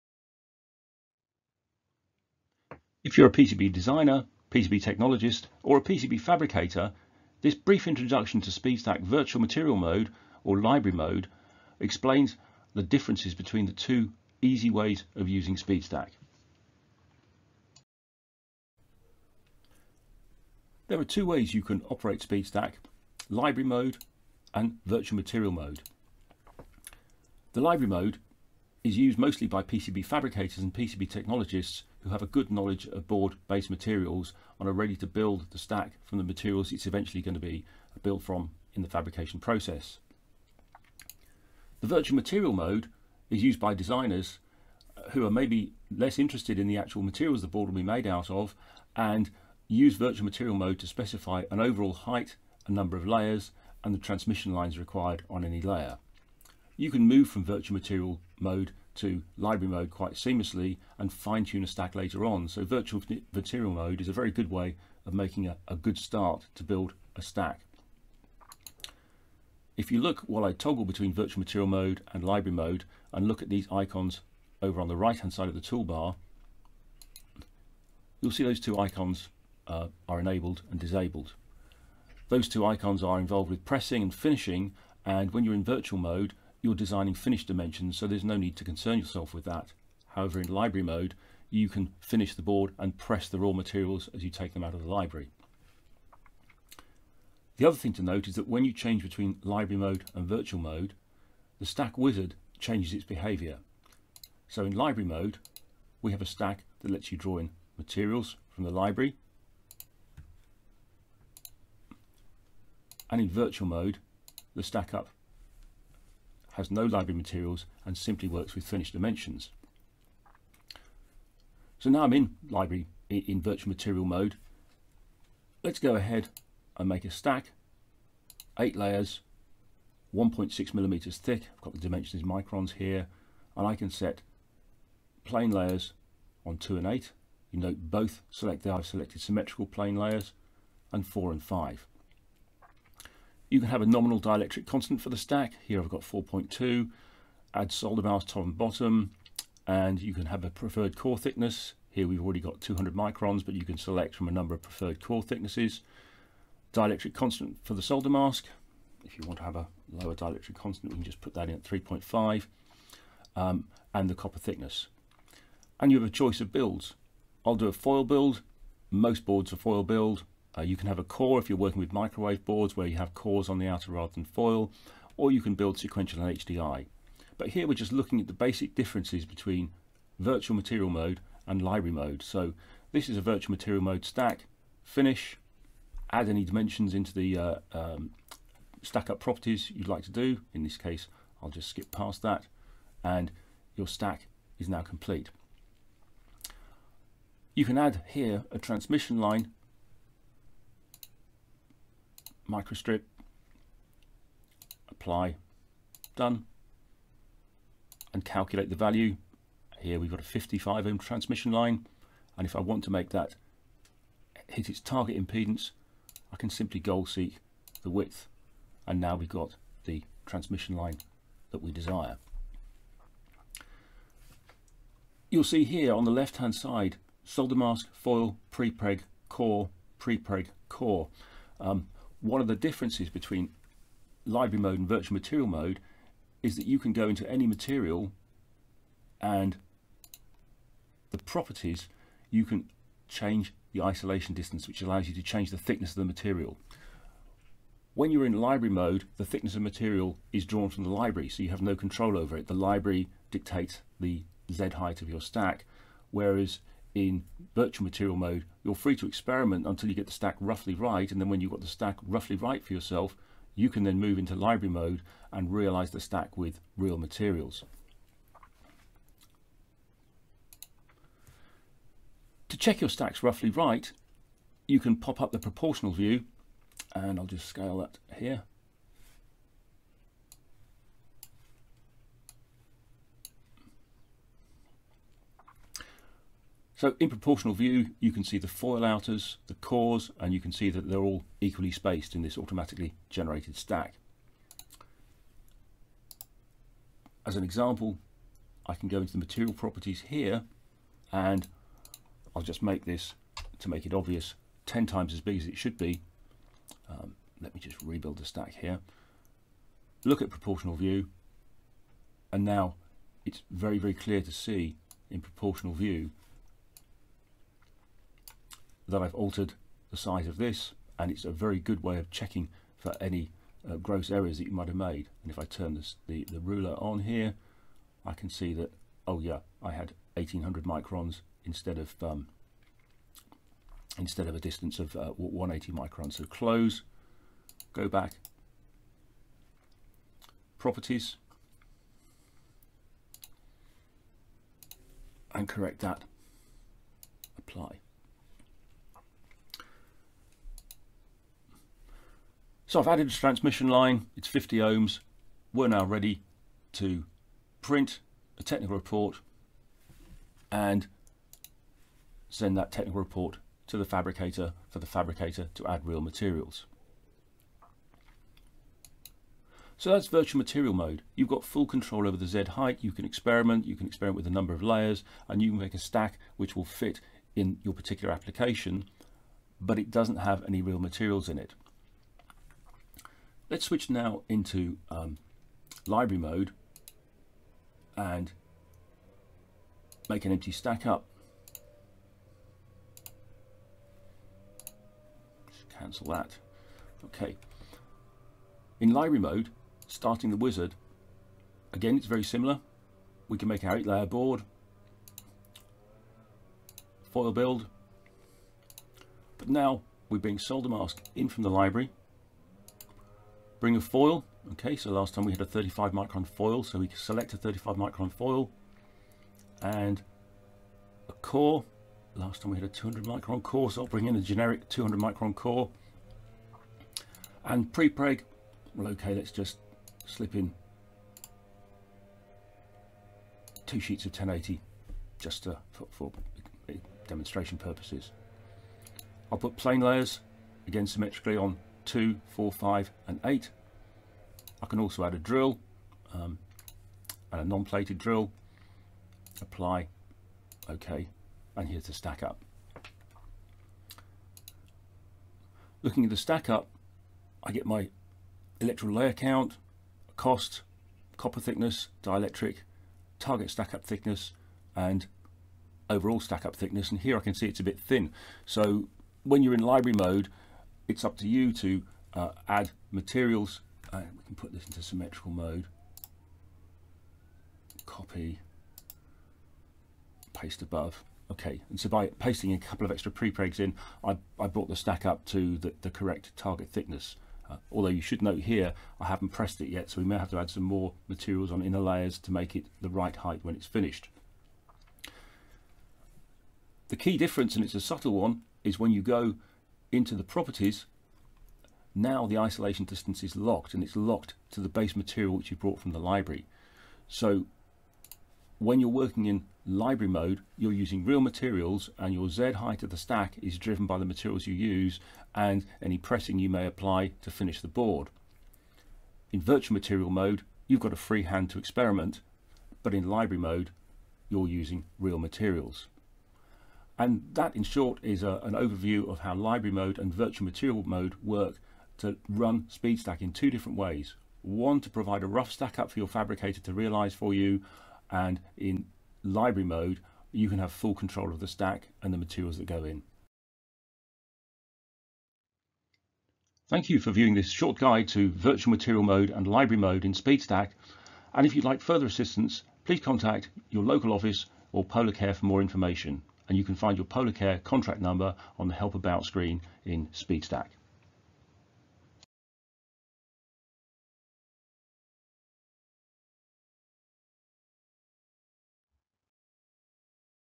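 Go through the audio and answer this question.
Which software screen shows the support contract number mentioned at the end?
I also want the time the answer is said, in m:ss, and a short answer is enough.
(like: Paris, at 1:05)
Help About, at 9:18.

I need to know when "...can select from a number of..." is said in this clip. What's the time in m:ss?
2:33.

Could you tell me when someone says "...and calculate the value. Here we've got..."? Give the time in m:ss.
3:28.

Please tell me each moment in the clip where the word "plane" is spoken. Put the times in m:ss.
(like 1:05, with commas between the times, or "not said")
2:15, 2:19, 7:19.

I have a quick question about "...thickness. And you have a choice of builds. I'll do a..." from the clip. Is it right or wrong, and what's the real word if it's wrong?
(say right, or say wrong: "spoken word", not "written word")
right.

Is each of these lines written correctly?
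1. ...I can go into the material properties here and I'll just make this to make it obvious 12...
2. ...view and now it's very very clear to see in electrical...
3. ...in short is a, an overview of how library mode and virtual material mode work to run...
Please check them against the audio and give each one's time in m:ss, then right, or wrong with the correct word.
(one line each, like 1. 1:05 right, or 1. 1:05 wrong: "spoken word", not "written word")
1. 4:58 wrong: "10", not "12"
2. 5:10 wrong: "proportional", not "electrical"
3. 8:47 right.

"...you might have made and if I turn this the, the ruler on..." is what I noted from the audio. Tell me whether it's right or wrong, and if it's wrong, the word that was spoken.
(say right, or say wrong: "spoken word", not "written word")
right.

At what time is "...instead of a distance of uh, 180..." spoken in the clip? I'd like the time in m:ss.
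5:33.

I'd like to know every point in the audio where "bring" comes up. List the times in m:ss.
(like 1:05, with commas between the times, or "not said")
6:53, 7:03.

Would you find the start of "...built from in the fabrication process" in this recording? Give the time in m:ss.
0:38.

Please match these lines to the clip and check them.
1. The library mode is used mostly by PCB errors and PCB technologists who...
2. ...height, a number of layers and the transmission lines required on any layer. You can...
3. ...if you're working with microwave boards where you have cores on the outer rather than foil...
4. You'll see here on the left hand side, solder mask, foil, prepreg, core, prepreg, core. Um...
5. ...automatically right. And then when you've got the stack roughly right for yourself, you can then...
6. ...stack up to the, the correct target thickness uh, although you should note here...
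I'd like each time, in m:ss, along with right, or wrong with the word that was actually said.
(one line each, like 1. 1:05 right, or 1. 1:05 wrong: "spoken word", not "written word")
1. 0:27 wrong: "fabricators", not "errors"
2. 0:51 right
3. 2:51 right
4. 3:45 right
5. 4:20 wrong: "roughly", not "automatically"
6. 8:04 right.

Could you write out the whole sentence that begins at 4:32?
To check your stacks roughly right, you can pop up the proportional view and I'll just scale that here.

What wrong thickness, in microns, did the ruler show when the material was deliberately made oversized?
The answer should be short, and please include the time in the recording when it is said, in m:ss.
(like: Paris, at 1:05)
1800 microns, at 5:30.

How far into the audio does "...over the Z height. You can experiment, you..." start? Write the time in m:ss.
6:12.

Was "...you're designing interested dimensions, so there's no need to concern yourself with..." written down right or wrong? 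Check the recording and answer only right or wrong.
wrong.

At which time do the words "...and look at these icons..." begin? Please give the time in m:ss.
1:13.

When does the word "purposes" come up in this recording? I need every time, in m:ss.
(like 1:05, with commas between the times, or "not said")
7:17.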